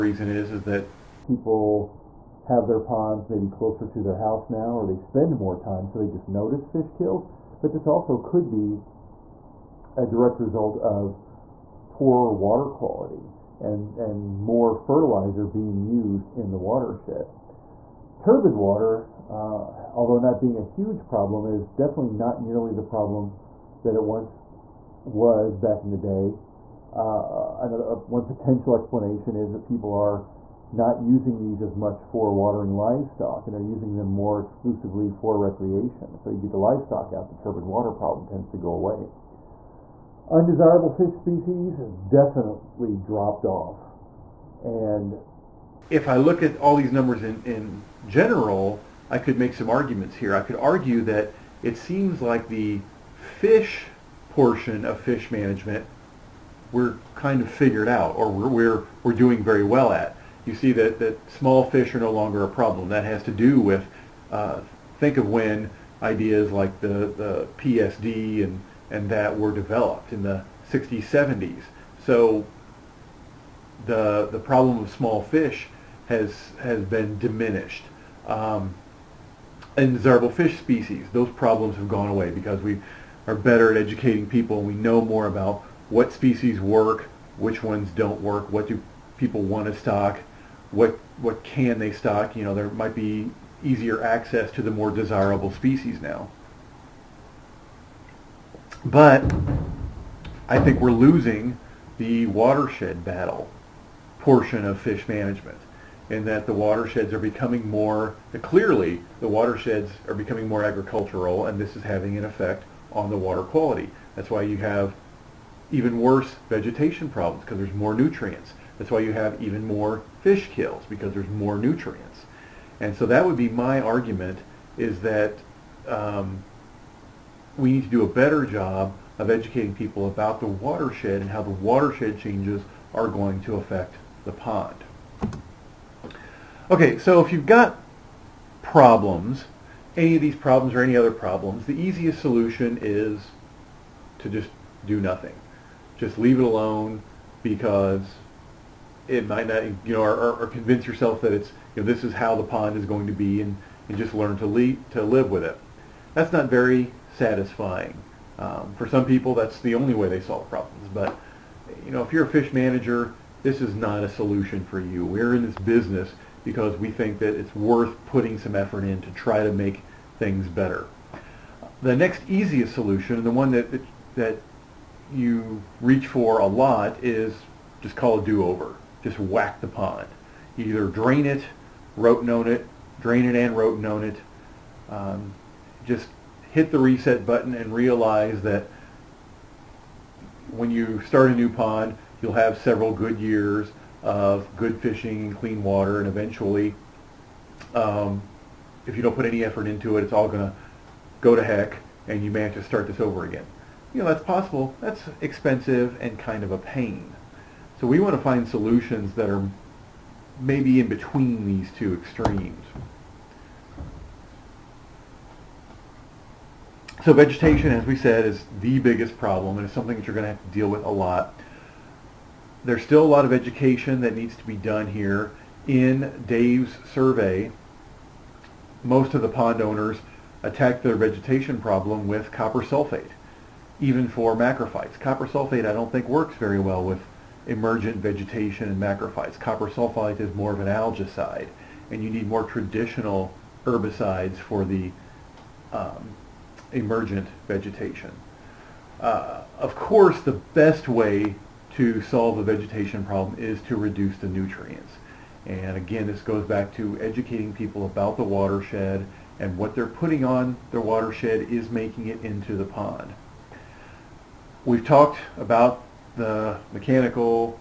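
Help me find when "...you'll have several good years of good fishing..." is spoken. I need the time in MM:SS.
03:12.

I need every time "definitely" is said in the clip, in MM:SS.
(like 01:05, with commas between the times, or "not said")
00:21, 00:42.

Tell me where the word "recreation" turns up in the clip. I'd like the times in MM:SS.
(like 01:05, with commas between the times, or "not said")
00:35.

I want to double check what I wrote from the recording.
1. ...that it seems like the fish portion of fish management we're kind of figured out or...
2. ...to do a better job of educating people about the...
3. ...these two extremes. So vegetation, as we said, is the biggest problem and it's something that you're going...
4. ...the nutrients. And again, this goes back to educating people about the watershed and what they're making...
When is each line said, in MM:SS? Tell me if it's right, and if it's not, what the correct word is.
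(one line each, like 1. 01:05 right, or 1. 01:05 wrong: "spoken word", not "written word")
1. 00:51 right
2. 02:07 right
3. 03:31 right
4. 04:14 wrong: "putting", not "making".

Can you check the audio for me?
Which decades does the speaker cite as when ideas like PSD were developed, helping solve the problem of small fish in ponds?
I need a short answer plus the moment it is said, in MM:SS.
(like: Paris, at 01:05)
60s, 70s, at 01:10.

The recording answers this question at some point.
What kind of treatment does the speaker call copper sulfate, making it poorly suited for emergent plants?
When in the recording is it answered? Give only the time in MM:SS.
04:00.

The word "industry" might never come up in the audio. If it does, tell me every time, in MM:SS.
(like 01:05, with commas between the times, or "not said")
not said.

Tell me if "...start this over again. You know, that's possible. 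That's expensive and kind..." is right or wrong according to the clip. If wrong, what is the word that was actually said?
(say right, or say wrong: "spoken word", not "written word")
right.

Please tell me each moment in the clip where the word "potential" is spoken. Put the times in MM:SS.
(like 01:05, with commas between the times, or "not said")
00:28.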